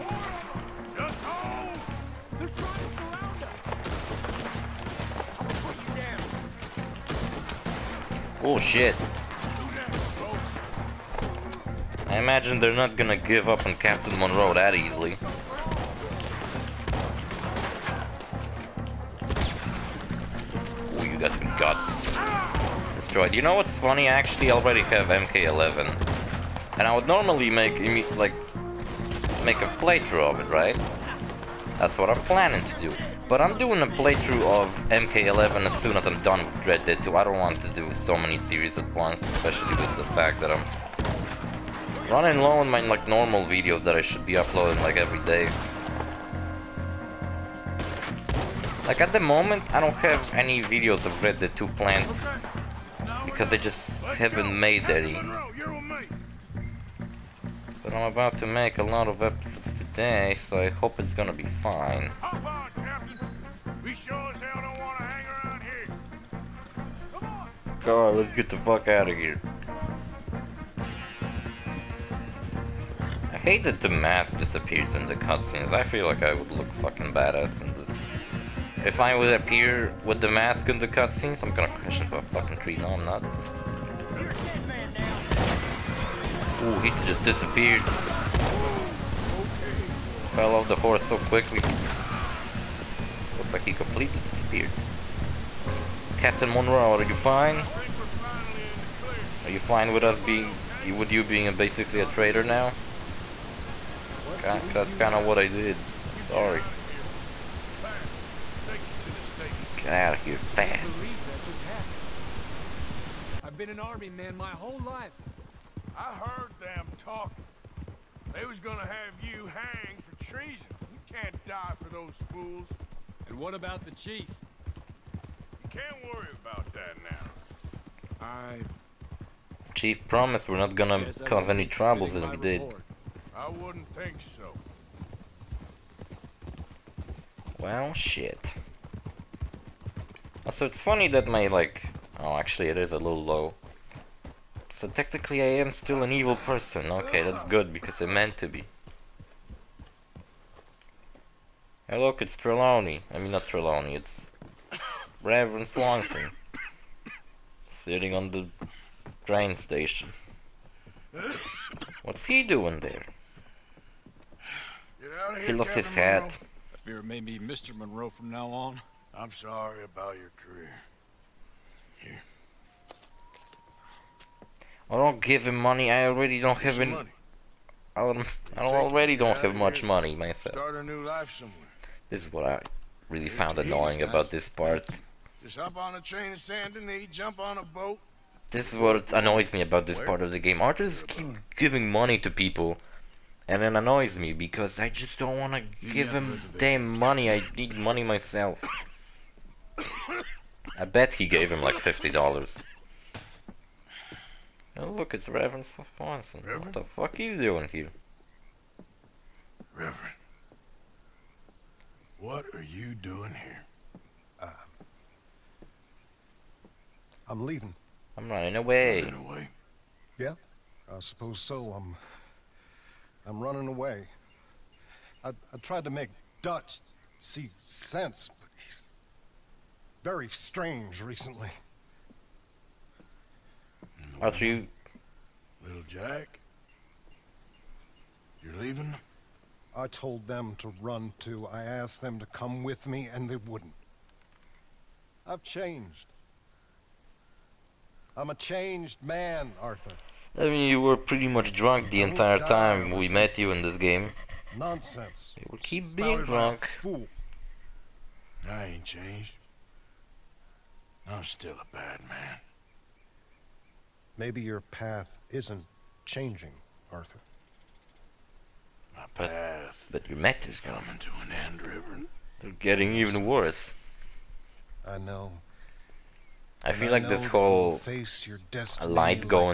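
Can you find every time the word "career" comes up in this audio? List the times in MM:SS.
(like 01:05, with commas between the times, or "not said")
02:50.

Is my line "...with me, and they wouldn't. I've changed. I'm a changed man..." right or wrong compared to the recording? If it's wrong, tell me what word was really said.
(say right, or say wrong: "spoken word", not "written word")
right.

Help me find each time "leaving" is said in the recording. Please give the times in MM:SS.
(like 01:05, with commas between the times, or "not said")
03:37, 03:58.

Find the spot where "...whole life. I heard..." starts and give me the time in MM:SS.
01:54.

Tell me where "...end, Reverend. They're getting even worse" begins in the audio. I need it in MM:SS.
04:31.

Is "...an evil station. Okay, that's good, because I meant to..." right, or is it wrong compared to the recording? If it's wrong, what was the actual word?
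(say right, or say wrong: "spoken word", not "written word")
wrong: "person", not "station".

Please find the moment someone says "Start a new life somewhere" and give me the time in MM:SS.
03:00.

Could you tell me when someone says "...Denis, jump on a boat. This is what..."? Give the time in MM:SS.
03:06.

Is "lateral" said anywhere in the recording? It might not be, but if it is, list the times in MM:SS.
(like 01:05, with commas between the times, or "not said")
not said.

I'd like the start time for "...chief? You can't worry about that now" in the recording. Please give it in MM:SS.
02:03.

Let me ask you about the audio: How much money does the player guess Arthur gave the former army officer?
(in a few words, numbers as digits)
$50.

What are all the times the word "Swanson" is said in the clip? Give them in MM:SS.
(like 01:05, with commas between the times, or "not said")
02:35, 03:25.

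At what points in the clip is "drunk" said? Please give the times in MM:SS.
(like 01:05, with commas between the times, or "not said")
04:11, 04:16.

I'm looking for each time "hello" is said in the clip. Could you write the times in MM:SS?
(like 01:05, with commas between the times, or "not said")
not said.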